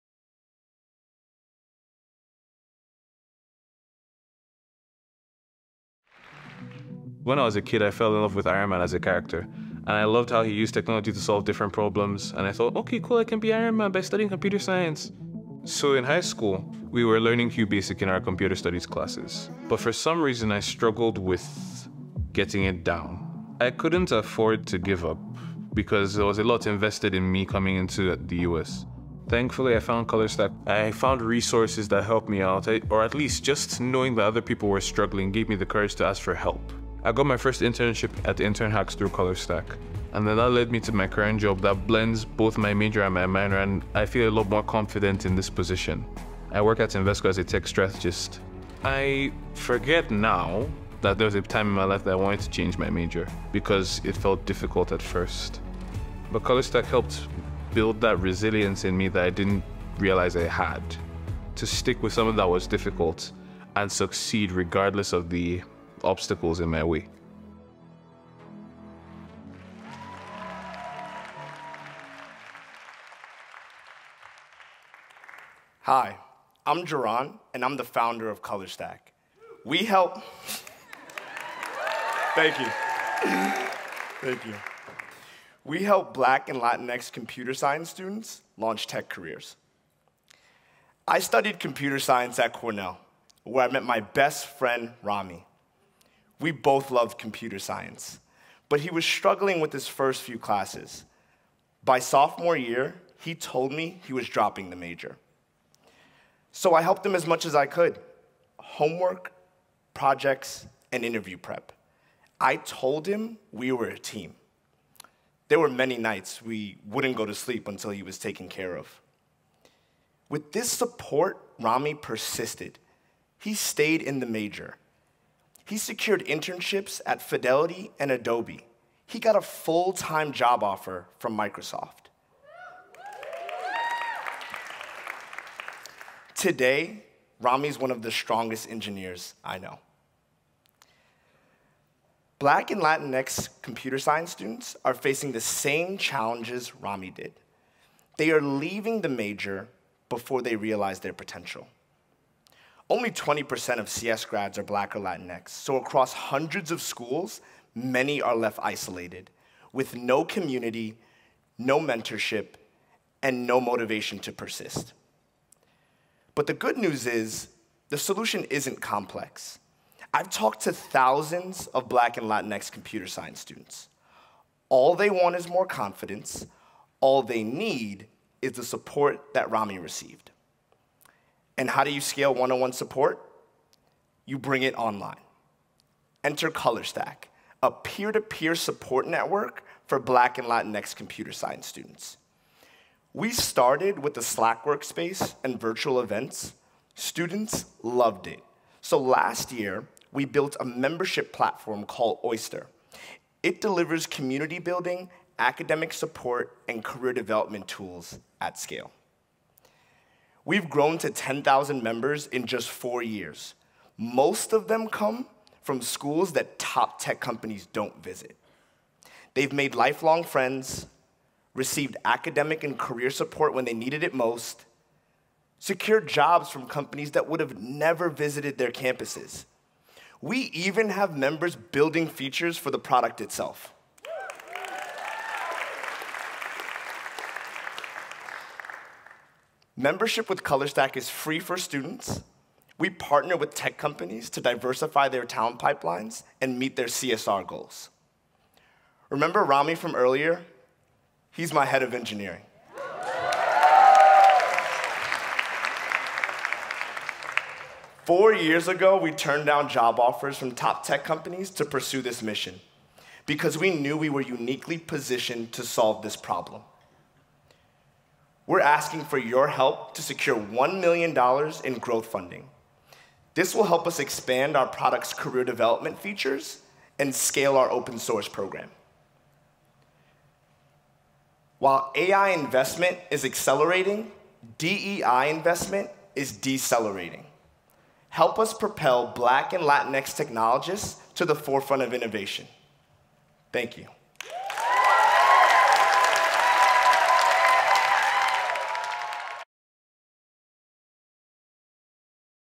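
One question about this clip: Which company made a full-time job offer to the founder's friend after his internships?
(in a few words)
Microsoft.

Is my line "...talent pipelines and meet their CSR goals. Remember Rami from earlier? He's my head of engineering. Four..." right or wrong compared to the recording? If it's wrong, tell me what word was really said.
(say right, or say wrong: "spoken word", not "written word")
right.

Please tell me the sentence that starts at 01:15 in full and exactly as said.
Hi, I'm Jehron, and I'm the founder of ColorStack.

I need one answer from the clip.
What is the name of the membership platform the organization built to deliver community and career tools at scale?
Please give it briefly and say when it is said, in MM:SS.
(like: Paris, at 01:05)
Oyster, at 03:22.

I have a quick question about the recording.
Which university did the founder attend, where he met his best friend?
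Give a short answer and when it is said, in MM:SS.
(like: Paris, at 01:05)
Cornell, at 01:32.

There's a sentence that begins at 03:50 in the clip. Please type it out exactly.
We even have members building features for the product itself.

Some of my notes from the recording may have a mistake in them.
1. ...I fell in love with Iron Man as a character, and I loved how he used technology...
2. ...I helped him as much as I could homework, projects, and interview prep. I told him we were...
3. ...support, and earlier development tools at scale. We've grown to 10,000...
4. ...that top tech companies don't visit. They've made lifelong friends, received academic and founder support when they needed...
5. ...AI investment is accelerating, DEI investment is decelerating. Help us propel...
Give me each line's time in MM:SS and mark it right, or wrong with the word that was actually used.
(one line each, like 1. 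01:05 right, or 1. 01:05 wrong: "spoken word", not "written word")
1. 00:07 right
2. 01:46 right
3. 03:25 wrong: "career", not "earlier"
4. 03:36 wrong: "career", not "founder"
5. 04:41 right.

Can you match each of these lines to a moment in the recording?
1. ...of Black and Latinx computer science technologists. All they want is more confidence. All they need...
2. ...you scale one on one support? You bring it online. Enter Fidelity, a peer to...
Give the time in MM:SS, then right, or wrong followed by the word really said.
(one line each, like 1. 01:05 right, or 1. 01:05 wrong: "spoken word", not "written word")
1. 02:51 wrong: "students", not "technologists"
2. 03:01 wrong: "ColorStack", not "Fidelity".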